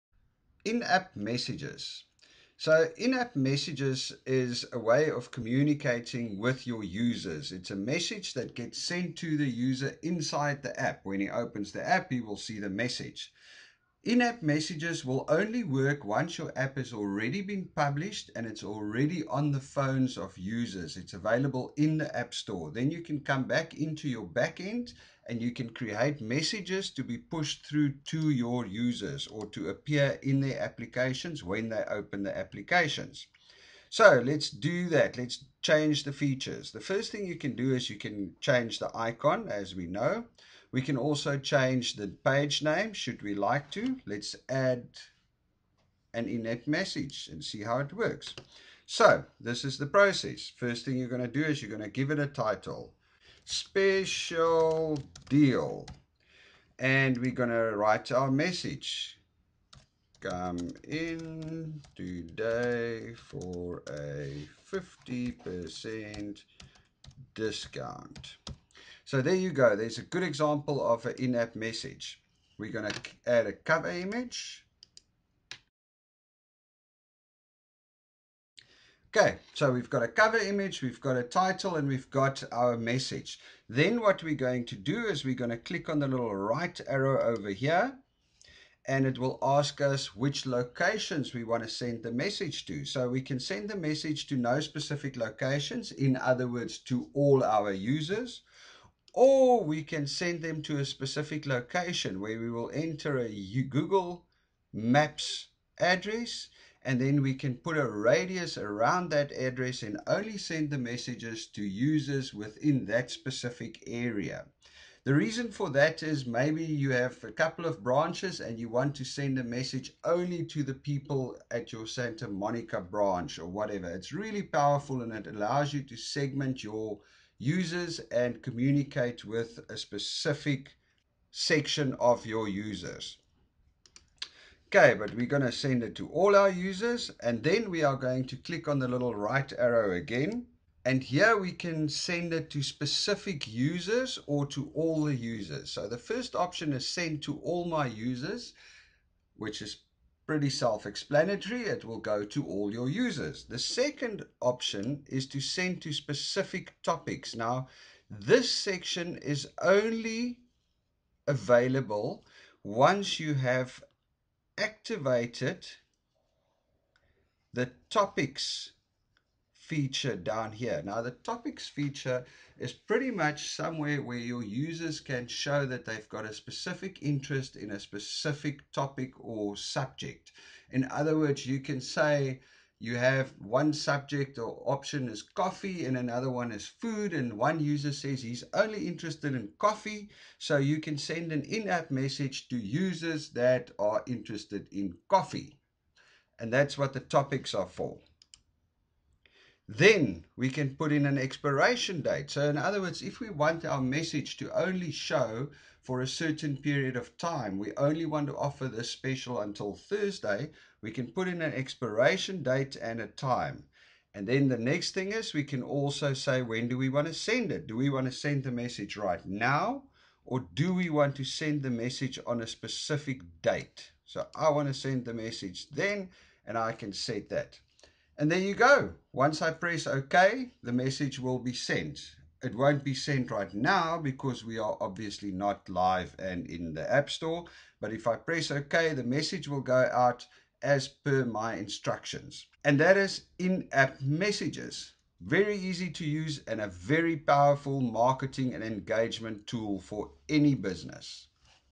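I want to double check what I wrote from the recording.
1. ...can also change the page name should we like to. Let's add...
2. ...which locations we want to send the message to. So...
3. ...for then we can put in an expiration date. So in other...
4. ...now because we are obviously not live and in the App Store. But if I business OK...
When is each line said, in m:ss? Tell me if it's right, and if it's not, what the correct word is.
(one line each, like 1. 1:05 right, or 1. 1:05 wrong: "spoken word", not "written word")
1. 0:40 right
2. 1:30 right
3. 3:17 right
4. 3:53 wrong: "press", not "business".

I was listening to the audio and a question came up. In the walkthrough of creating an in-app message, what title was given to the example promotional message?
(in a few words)
Special deal.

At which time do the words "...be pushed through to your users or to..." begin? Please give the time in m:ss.
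0:27.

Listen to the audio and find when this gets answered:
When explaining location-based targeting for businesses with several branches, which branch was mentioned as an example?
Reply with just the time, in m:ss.
2:01.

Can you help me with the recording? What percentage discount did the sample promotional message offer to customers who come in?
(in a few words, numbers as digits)
50%.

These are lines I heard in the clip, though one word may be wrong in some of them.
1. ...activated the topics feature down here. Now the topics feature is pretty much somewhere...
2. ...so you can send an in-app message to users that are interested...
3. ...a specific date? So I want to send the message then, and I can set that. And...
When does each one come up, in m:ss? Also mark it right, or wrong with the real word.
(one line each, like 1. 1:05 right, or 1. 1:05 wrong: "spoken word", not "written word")
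1. 2:44 right
2. 3:10 right
3. 3:42 right.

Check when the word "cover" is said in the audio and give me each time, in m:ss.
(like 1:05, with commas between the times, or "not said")
1:13, 1:20.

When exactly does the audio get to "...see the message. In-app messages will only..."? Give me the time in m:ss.
0:12.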